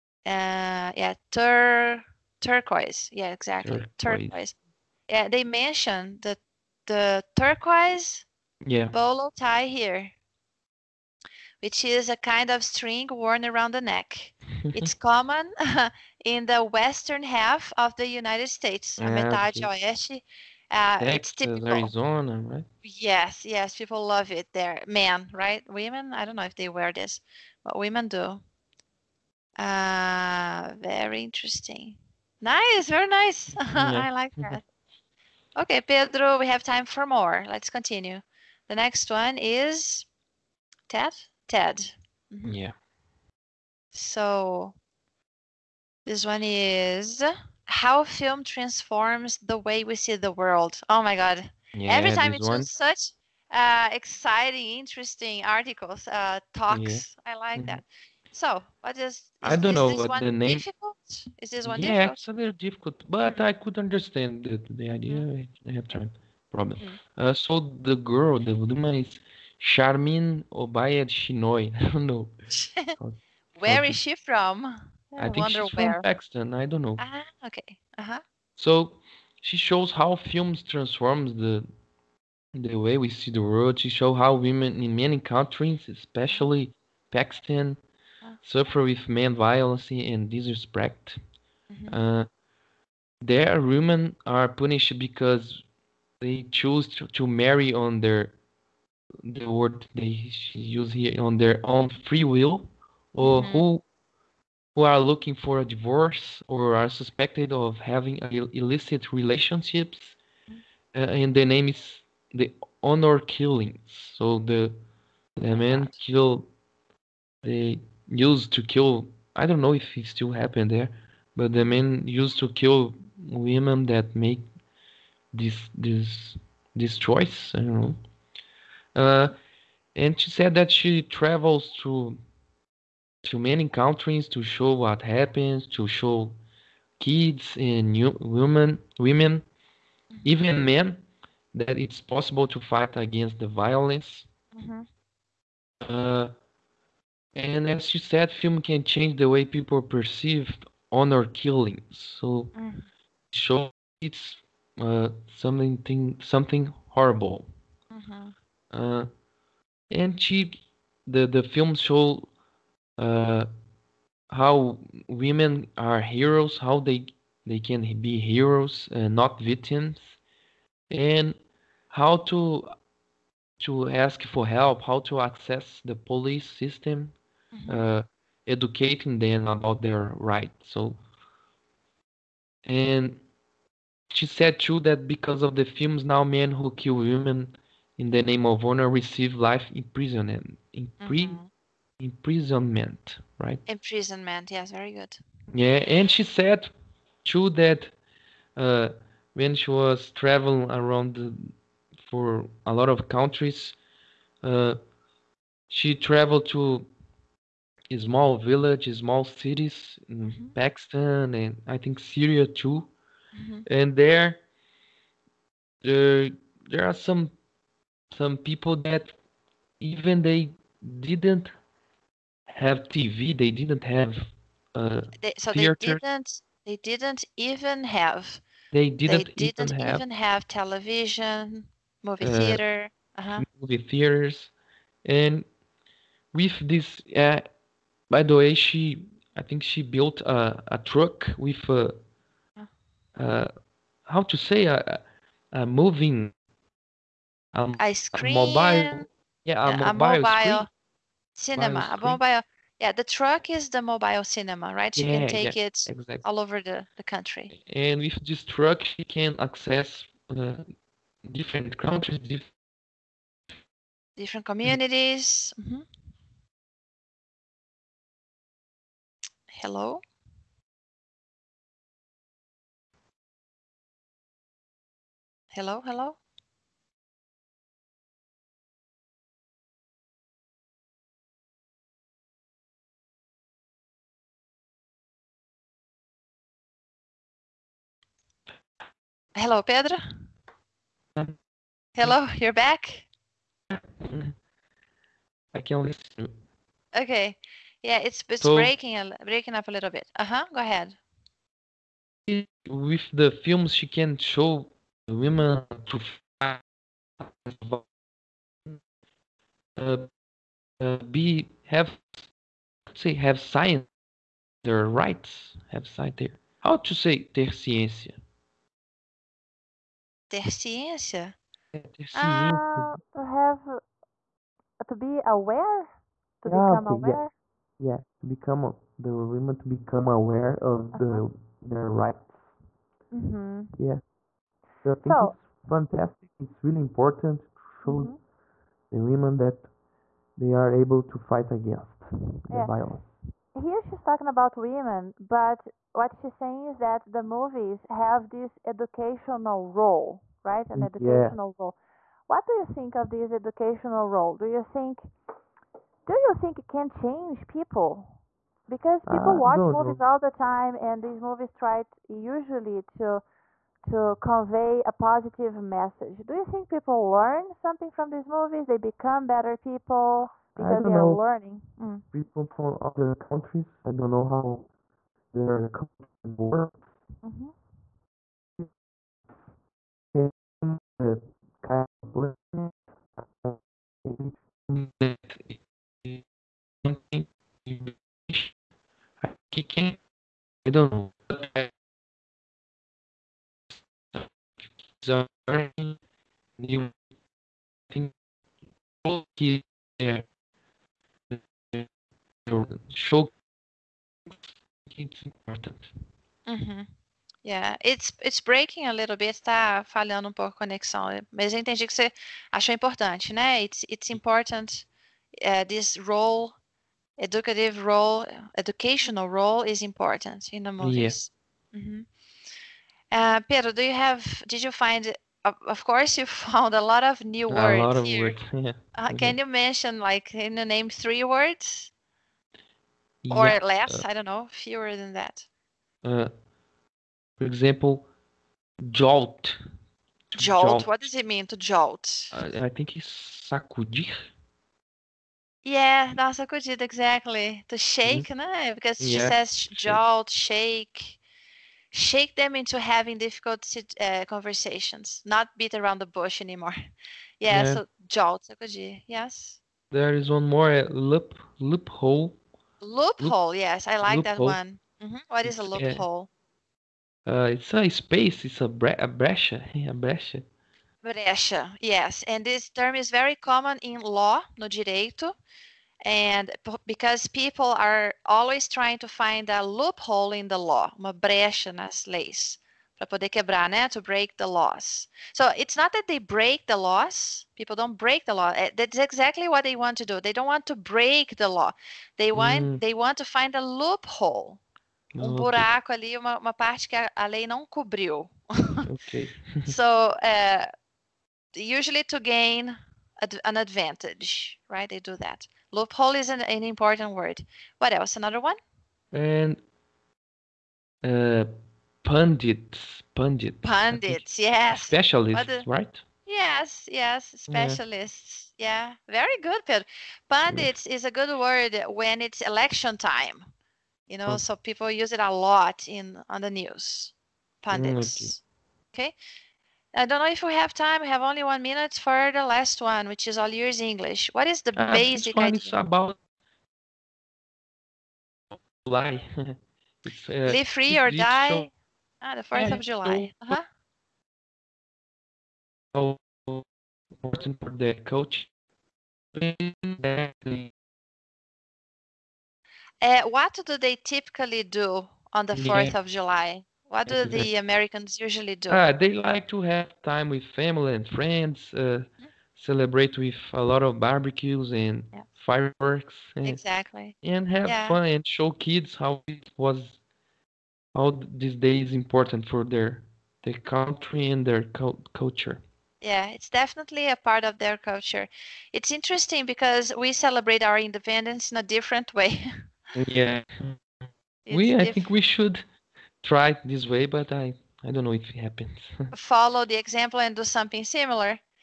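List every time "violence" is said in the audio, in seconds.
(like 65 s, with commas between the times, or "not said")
89 s, 143 s, 342 s.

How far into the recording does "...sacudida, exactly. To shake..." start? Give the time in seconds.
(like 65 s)
446 s.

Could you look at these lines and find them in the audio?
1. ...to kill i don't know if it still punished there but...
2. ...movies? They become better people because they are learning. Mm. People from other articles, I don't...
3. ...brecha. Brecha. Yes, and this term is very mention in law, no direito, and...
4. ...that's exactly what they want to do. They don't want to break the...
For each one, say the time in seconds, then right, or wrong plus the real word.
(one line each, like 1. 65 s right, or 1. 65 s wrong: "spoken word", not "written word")
1. 118 s wrong: "happened", not "punished"
2. 368 s wrong: "countries", not "articles"
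3. 469 s wrong: "common", not "mention"
4. 488 s right.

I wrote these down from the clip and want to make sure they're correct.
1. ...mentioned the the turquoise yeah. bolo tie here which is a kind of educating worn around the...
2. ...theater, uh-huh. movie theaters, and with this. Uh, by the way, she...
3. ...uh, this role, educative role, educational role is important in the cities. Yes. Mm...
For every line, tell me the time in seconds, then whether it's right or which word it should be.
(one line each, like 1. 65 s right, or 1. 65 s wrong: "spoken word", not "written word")
1. 5 s wrong: "string", not "educating"
2. 232 s right
3. 415 s wrong: "movies", not "cities".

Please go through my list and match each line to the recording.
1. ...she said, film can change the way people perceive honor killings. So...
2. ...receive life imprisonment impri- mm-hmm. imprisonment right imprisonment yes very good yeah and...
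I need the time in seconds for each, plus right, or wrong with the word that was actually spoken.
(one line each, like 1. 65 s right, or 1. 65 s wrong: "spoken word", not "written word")
1. 147 s right
2. 188 s right.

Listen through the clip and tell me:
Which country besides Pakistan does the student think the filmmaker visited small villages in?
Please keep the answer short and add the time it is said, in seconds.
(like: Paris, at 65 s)
Syria, at 211 s.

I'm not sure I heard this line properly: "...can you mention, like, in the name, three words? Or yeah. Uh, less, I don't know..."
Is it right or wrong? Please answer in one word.
right.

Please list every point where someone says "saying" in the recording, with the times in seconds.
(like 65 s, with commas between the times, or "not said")
346 s.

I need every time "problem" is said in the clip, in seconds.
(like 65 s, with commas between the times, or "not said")
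66 s.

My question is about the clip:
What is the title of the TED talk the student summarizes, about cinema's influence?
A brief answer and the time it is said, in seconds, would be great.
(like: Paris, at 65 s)
How film transforms the way we see the world, at 47 s.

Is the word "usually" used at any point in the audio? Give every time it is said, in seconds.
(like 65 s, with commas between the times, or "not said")
362 s, 501 s, 558 s.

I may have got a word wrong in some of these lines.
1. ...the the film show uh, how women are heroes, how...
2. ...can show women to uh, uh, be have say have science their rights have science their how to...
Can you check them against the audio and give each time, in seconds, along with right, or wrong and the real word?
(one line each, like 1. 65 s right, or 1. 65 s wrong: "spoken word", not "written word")
1. 161 s right
2. 303 s right.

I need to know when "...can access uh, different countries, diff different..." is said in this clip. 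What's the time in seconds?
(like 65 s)
259 s.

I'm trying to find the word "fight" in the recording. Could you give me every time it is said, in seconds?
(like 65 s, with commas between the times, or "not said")
142 s, 341 s.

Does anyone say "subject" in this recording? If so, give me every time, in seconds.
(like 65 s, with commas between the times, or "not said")
not said.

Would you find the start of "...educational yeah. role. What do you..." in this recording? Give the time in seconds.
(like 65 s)
350 s.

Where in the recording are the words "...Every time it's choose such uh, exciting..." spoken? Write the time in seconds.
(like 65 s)
51 s.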